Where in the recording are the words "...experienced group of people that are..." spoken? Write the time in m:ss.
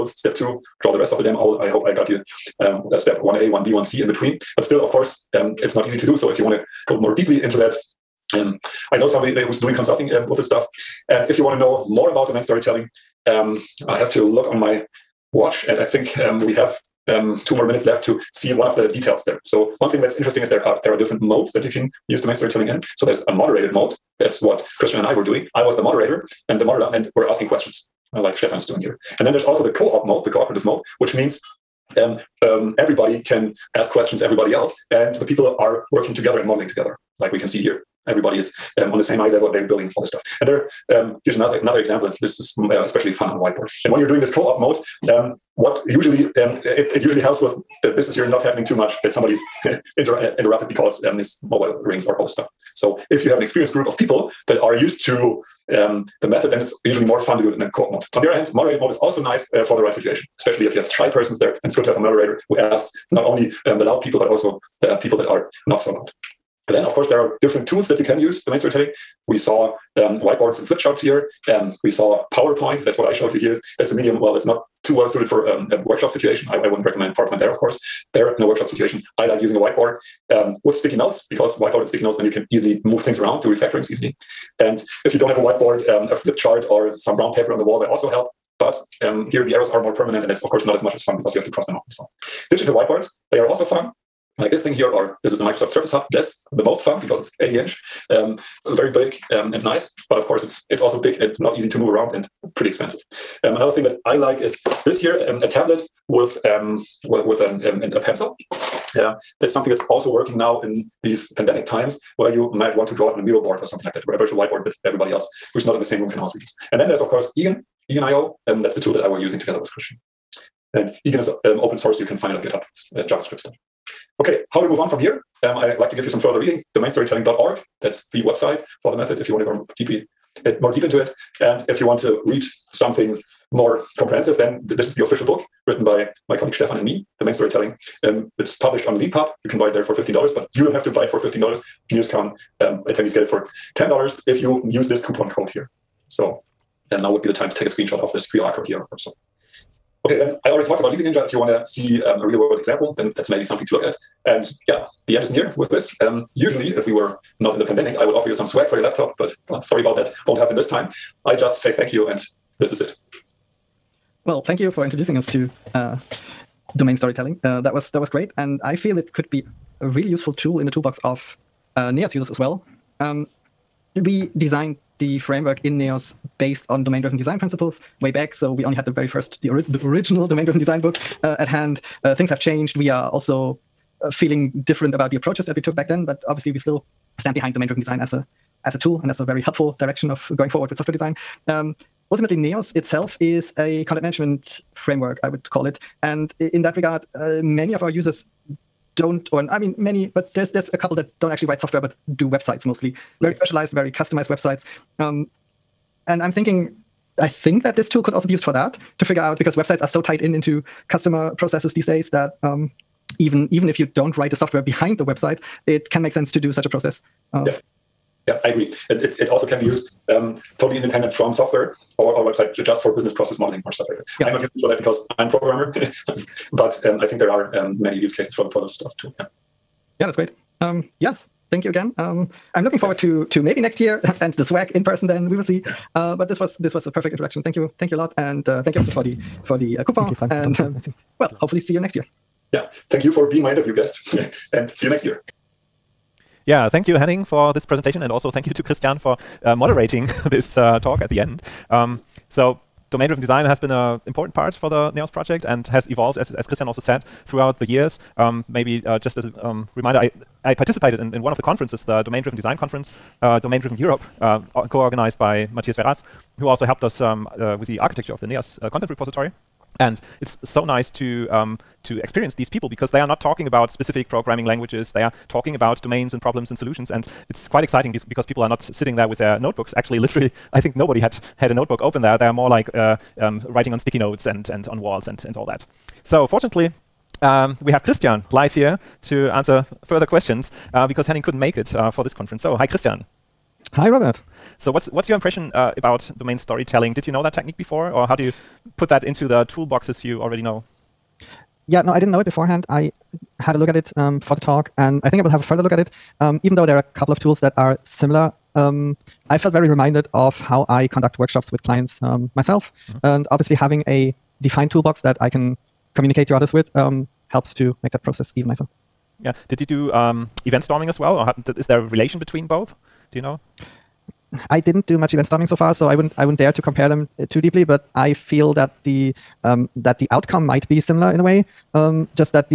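0:53.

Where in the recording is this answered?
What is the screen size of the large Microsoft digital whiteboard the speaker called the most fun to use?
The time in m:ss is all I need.
1:37.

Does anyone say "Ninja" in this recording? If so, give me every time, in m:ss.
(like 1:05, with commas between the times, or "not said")
2:31.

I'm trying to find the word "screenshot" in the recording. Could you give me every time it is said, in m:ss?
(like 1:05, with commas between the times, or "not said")
2:27.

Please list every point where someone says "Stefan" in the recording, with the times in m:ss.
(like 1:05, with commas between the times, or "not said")
0:28, 2:16.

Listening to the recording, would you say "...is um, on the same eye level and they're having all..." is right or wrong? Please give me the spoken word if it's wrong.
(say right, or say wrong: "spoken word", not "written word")
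wrong: "building", not "having".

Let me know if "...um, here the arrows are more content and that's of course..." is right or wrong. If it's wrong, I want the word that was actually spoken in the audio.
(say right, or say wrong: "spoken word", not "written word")
wrong: "permanent", not "content".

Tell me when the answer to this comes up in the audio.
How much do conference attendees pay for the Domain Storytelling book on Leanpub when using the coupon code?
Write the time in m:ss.
2:23.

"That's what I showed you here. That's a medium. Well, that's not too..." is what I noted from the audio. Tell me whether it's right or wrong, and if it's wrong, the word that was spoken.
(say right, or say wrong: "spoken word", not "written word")
right.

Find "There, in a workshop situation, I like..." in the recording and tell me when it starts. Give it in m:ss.
1:18.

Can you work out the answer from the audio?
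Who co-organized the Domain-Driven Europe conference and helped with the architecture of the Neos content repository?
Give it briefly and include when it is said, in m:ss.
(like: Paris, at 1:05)
Mathias Verraes, at 4:25.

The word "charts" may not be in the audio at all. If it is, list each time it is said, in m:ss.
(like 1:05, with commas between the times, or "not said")
1:10, 1:26.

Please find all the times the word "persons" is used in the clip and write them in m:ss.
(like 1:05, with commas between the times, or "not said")
1:01, 3:54.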